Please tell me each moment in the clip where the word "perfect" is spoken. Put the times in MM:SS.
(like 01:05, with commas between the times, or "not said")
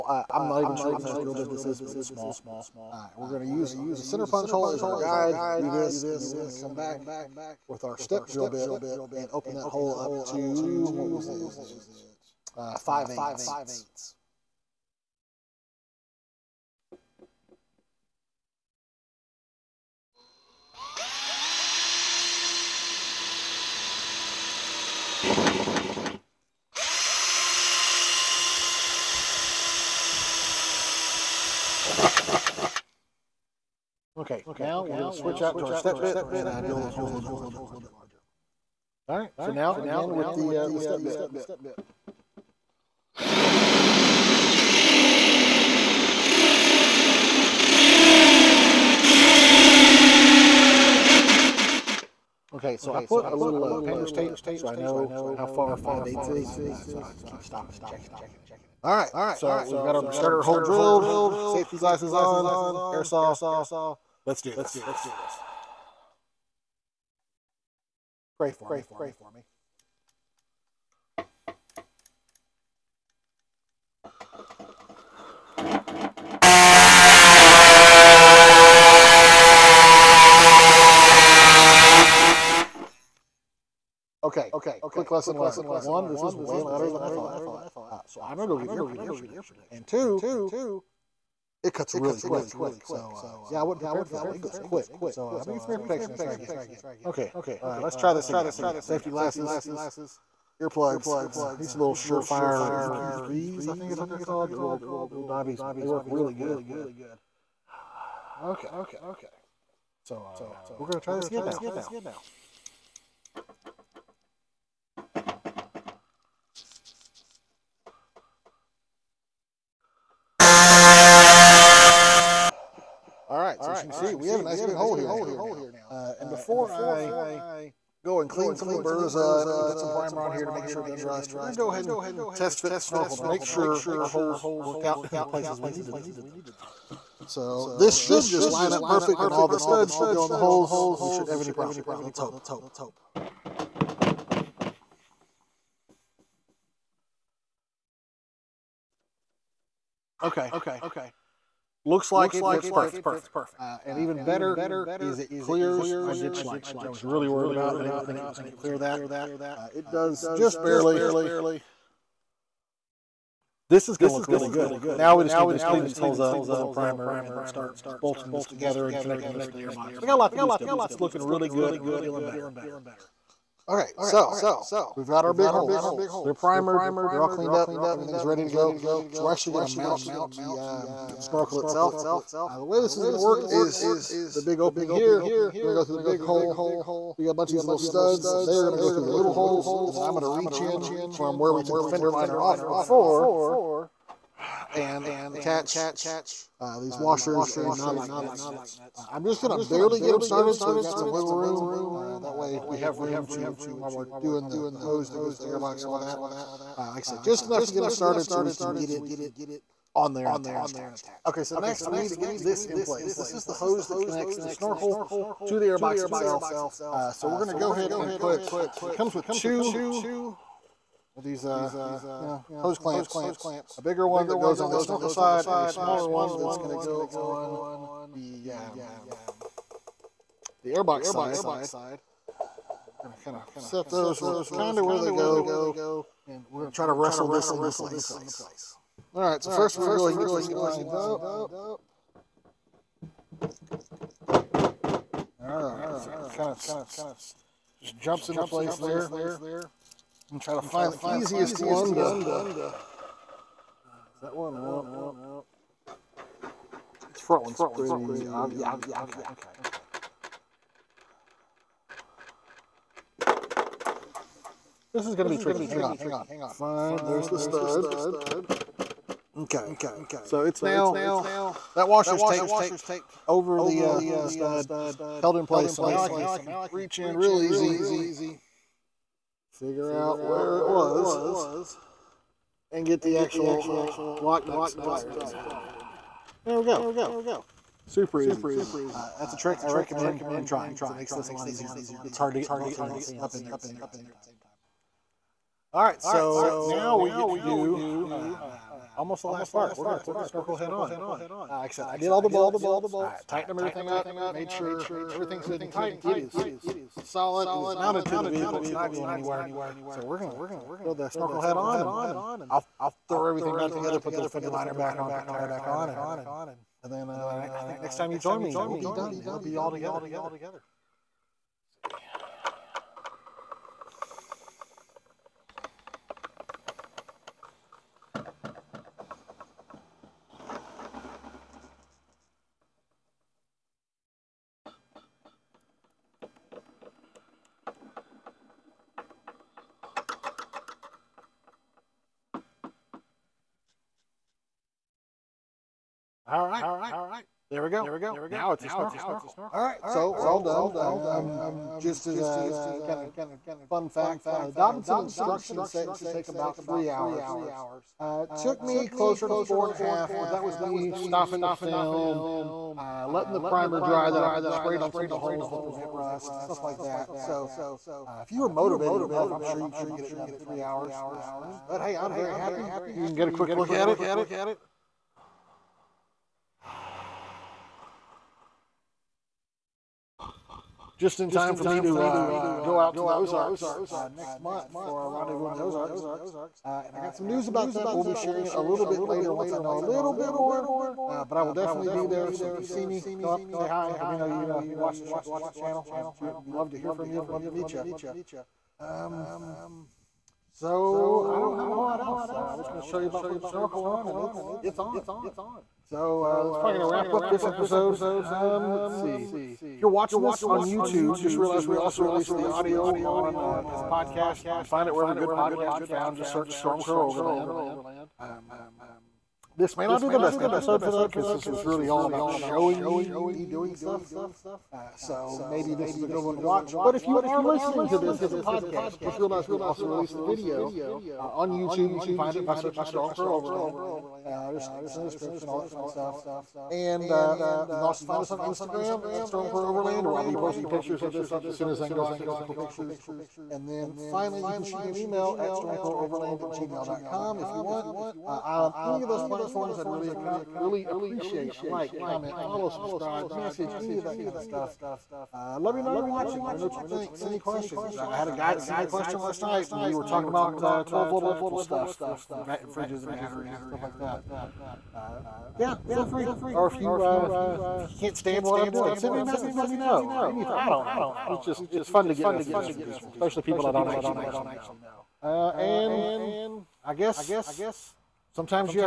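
02:18, 02:32.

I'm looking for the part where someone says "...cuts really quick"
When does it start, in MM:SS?
01:31.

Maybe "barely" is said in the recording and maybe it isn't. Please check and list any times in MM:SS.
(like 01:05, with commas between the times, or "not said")
02:40, 03:19.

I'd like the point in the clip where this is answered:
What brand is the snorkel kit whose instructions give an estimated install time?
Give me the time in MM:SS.
05:54.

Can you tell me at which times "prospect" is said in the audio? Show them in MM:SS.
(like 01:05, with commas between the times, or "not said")
not said.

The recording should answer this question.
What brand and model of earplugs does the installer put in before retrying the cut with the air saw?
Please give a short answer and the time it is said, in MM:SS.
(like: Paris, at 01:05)
Surefire EP3, at 01:41.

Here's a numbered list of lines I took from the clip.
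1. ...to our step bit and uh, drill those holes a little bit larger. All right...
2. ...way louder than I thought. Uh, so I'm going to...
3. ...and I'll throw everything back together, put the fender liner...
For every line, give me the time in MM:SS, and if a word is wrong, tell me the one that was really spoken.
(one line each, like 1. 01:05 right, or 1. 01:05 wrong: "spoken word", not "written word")
1. 00:35 right
2. 01:26 right
3. 05:11 right.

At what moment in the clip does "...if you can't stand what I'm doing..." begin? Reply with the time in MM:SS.
07:47.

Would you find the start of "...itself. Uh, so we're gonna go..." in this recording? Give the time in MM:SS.
03:36.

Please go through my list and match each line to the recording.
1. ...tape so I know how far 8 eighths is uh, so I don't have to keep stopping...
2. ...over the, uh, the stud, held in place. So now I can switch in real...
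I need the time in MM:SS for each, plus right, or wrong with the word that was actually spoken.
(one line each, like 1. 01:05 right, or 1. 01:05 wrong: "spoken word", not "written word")
1. 00:54 wrong: "5", not "8"
2. 04:33 wrong: "reach", not "switch".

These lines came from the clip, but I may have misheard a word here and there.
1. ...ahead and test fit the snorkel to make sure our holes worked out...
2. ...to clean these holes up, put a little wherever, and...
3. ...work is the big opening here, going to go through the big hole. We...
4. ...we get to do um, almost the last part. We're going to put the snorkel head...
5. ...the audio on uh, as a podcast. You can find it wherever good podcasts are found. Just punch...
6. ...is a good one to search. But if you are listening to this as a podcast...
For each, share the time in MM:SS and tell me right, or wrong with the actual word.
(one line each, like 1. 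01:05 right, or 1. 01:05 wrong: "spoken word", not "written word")
1. 02:11 right
2. 02:45 wrong: "primer", not "wherever"
3. 03:03 right
4. 04:56 right
5. 06:52 wrong: "search", not "punch"
6. 07:05 wrong: "watch", not "search".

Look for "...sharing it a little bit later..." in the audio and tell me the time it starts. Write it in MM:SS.
06:28.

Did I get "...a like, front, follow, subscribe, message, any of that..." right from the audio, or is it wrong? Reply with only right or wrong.
wrong.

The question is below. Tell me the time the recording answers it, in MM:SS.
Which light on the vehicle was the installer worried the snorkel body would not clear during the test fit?
02:36.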